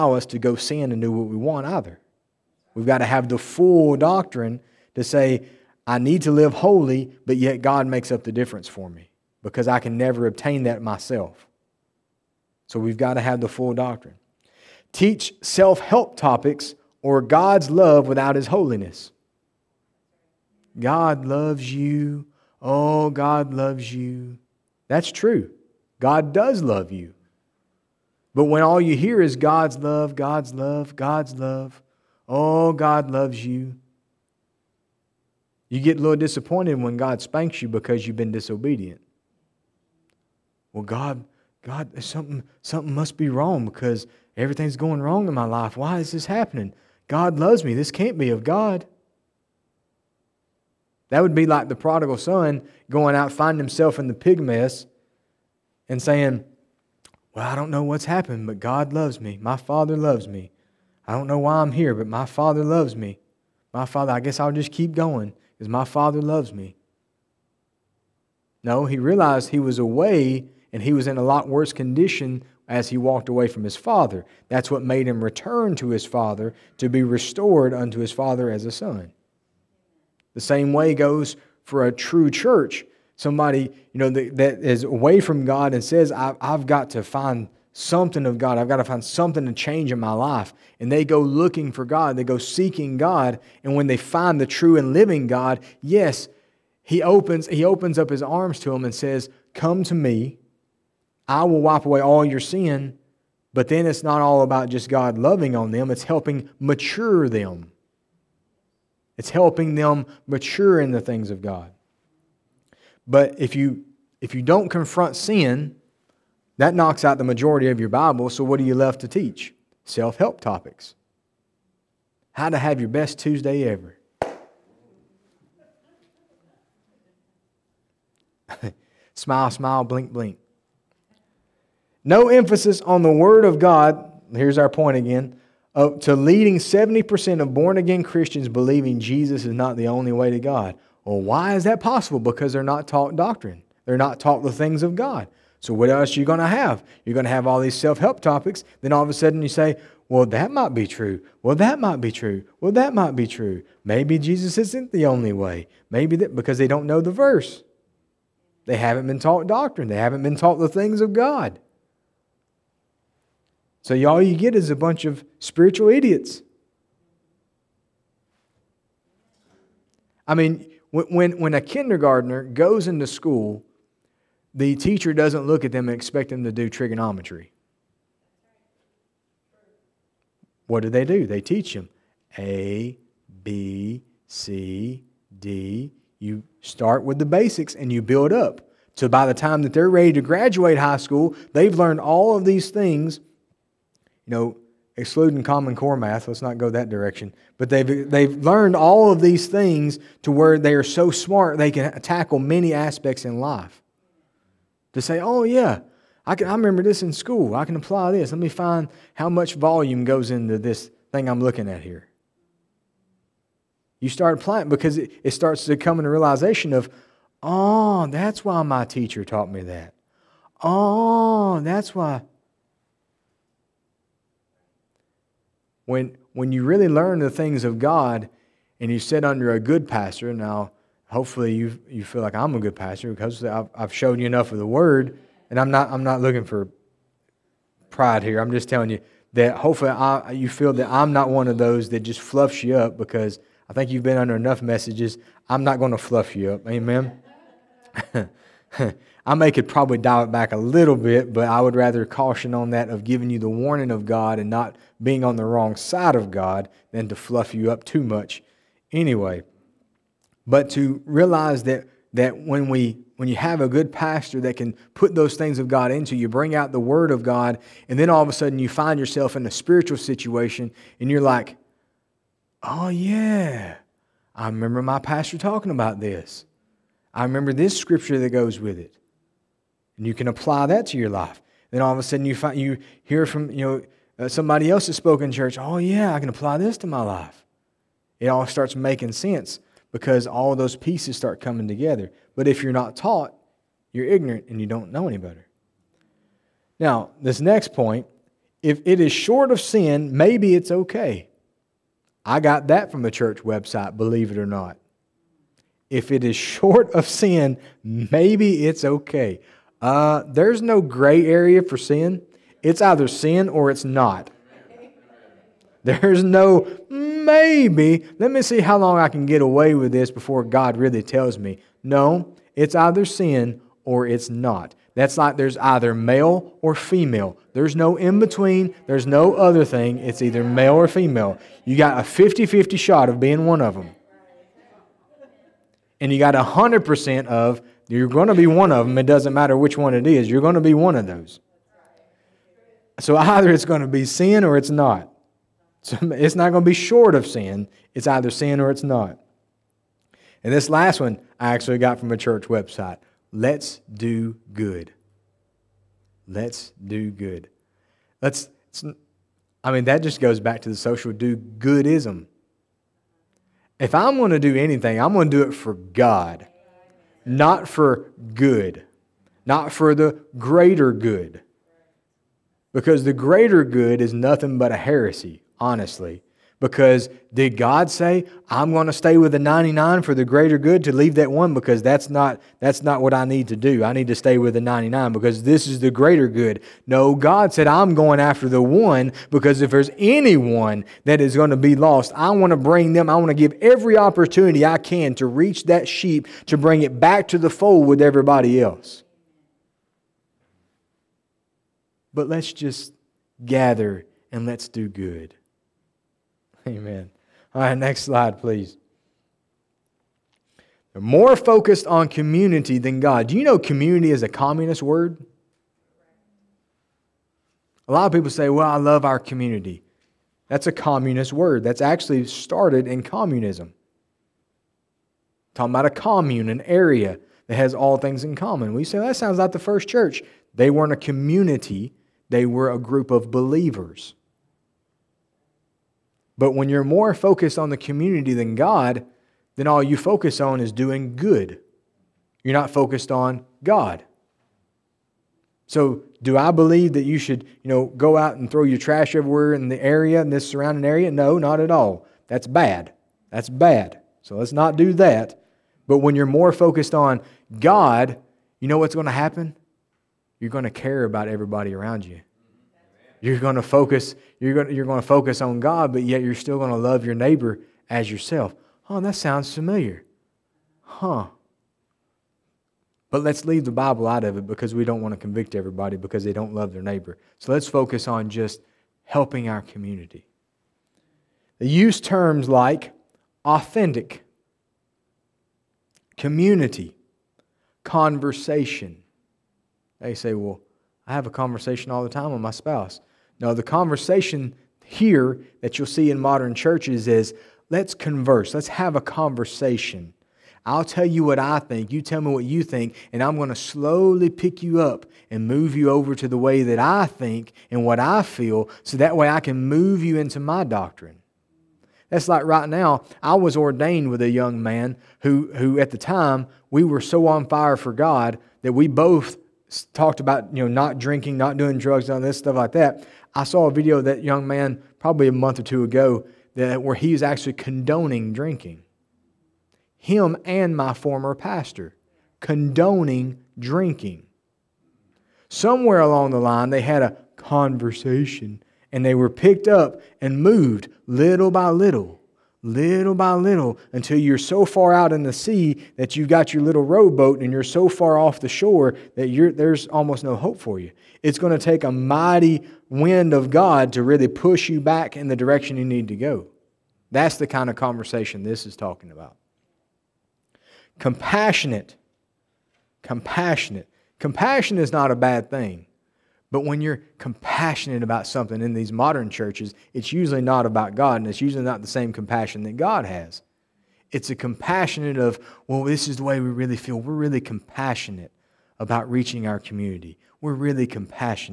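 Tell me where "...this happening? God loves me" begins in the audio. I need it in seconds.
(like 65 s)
46 s.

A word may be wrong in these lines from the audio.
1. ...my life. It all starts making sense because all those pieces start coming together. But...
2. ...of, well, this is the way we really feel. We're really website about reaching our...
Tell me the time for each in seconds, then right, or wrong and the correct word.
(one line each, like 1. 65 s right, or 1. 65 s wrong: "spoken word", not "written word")
1. 286 s right
2. 575 s wrong: "compassionate", not "website".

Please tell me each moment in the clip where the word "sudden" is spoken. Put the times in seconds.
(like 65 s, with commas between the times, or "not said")
149 s, 268 s, 282 s.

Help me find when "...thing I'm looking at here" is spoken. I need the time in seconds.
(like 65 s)
211 s.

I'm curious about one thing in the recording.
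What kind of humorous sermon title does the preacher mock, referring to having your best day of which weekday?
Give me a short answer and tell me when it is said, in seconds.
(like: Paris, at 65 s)
Tuesday, at 123 s.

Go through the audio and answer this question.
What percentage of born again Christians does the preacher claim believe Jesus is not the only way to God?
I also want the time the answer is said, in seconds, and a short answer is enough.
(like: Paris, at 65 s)
70%, at 136 s.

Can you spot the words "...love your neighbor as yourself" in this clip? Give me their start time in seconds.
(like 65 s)
466 s.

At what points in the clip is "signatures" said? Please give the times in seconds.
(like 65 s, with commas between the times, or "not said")
not said.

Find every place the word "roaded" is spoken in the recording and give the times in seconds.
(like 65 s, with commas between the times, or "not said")
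not said.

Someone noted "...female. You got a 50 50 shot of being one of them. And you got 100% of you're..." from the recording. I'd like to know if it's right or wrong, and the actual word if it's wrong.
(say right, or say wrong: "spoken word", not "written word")
right.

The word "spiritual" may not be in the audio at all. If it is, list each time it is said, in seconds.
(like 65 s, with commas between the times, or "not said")
165 s, 269 s.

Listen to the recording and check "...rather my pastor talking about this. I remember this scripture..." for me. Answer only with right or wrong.
wrong.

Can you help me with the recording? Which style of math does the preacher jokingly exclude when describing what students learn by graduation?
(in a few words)
Common Core.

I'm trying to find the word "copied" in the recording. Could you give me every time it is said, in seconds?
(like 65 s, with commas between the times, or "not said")
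not said.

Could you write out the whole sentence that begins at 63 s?
My Father, I guess I'll just keep going because my Father loves me.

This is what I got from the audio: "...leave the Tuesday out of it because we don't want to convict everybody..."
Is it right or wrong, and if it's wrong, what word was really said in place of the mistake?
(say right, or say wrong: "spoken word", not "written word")
wrong: "Bible", not "Tuesday".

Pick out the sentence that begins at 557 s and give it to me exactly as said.
That's the kind of conversation this is talking about.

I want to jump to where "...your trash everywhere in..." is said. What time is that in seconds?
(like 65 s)
448 s.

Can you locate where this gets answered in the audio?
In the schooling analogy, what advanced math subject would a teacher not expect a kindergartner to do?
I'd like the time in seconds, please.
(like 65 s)
176 s.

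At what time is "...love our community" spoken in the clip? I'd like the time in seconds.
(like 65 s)
418 s.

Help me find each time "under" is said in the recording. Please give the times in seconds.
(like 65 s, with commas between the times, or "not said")
229 s, 244 s.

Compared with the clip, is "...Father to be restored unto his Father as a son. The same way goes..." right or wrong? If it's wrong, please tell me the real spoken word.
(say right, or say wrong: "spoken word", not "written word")
right.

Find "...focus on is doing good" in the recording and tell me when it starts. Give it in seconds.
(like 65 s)
439 s.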